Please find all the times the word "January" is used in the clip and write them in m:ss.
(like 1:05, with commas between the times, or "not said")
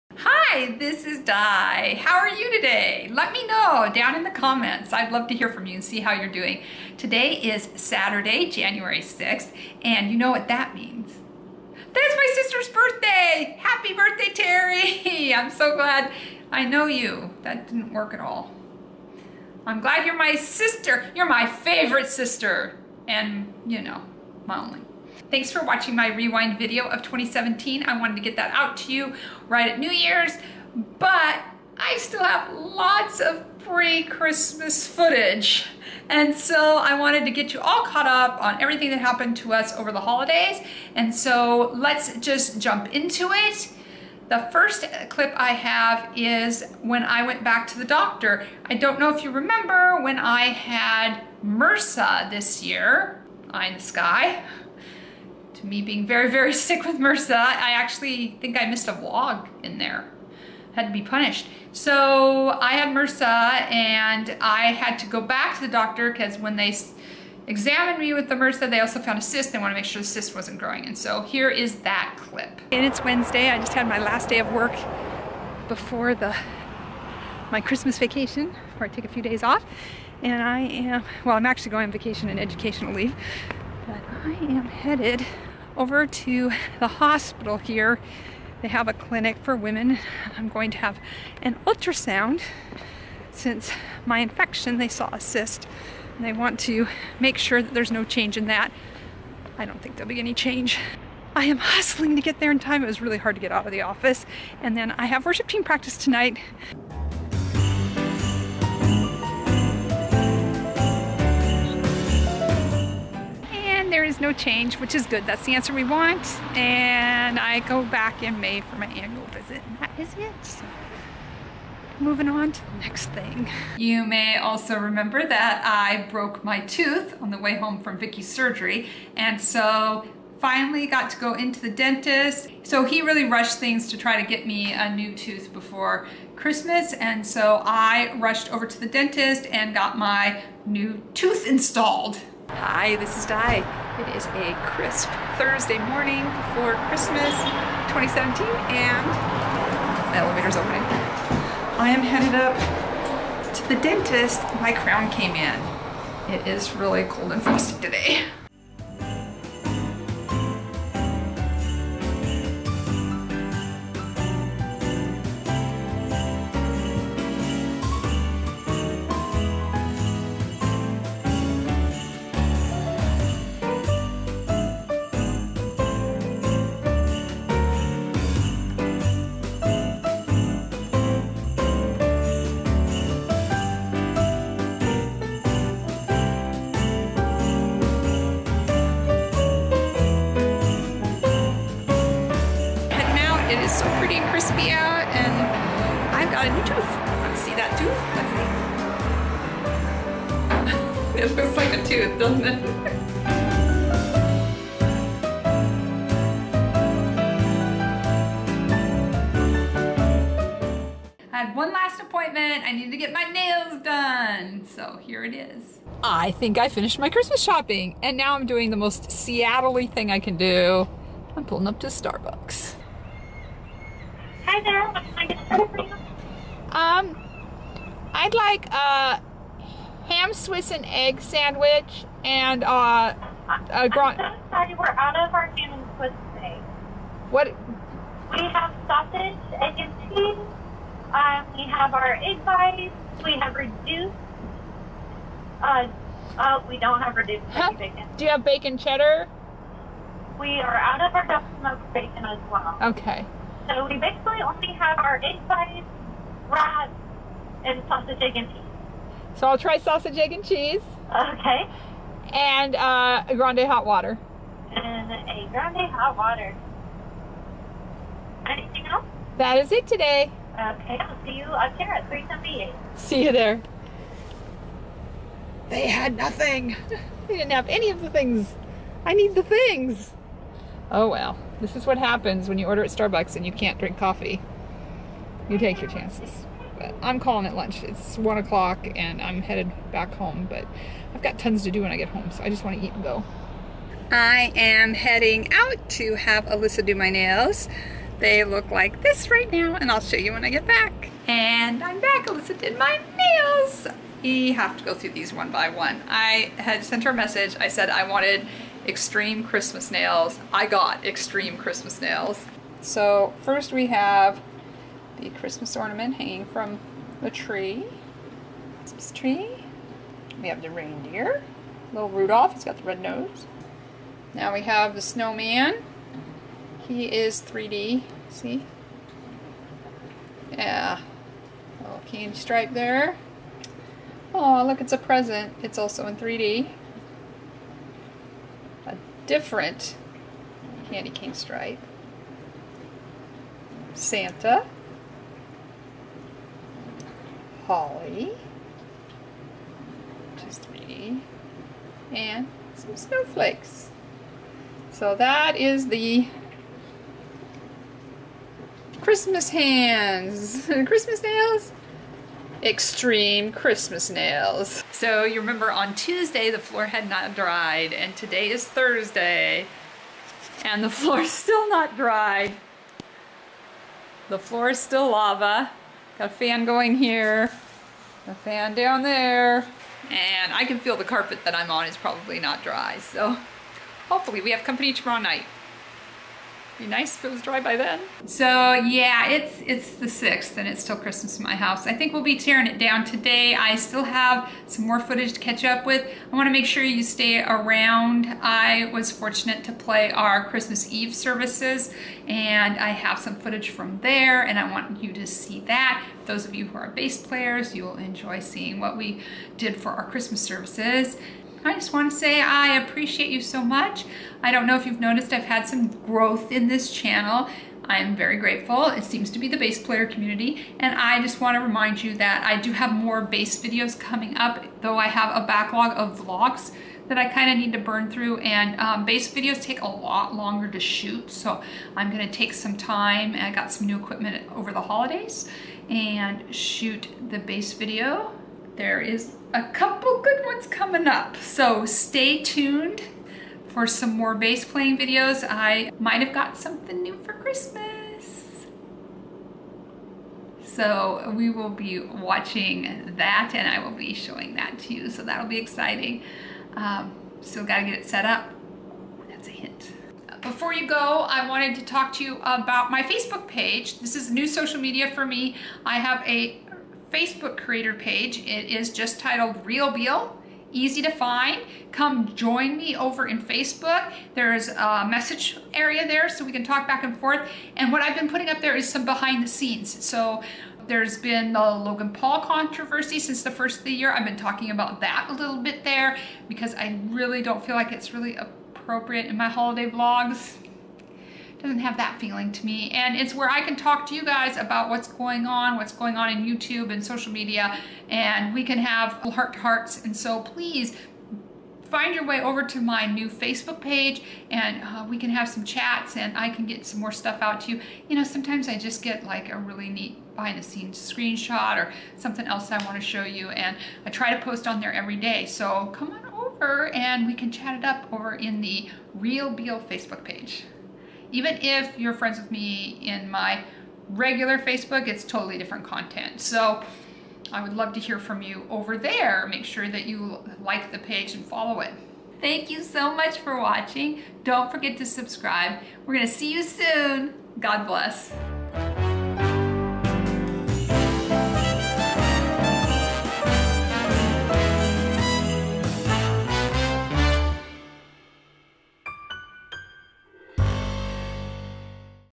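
0:08.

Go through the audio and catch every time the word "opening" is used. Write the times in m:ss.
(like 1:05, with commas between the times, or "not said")
2:30.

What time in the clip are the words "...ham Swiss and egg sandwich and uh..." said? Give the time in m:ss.
3:50.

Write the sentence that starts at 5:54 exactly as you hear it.
So that is the Christmas hands.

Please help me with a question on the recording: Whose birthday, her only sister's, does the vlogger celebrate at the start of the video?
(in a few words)
Terry.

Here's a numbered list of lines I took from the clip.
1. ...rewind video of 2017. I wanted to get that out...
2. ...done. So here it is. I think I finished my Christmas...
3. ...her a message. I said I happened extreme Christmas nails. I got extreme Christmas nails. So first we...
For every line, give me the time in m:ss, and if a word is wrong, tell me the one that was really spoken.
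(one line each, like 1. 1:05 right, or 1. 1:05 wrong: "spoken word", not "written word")
1. 0:26 right
2. 3:33 right
3. 5:07 wrong: "wanted", not "happened".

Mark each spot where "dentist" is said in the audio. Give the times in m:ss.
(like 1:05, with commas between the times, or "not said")
2:11, 2:18, 2:33.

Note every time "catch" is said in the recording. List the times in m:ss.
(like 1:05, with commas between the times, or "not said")
6:35.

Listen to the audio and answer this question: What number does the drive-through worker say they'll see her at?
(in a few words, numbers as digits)
378.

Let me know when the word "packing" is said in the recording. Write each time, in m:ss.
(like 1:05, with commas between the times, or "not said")
not said.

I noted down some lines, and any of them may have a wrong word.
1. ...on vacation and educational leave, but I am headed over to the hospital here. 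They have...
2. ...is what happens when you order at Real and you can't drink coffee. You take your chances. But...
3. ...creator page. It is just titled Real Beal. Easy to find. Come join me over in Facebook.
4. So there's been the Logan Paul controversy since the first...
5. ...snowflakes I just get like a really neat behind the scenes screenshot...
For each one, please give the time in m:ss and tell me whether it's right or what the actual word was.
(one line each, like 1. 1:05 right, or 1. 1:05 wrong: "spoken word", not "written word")
1. 1:21 right
2. 4:41 wrong: "Starbucks", not "Real"
3. 7:47 right
4. 8:00 right
5. 8:28 wrong: "sometimes", not "snowflakes".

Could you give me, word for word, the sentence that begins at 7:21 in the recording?
So stay tuned for some more bass playing videos.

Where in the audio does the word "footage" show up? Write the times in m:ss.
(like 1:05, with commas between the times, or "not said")
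0:34, 6:34, 6:43.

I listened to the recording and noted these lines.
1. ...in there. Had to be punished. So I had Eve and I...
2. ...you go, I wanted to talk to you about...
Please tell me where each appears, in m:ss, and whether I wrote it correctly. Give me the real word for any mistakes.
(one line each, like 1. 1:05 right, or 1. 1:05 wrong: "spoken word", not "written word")
1. 0:59 wrong: "MRSA", not "Eve"
2. 7:40 right.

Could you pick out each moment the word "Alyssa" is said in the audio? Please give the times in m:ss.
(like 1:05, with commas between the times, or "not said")
4:56, 5:02.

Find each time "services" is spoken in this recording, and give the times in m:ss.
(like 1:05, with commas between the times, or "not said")
6:41, 6:50.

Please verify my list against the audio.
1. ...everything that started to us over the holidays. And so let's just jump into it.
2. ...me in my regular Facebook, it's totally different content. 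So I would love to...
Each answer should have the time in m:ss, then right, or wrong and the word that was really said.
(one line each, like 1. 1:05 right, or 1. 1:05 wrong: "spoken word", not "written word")
1. 0:38 wrong: "happened", not "started"
2. 8:42 right.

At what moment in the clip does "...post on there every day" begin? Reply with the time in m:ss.
8:34.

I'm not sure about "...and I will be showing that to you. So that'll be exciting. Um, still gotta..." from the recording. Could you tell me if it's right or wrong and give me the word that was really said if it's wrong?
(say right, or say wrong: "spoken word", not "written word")
right.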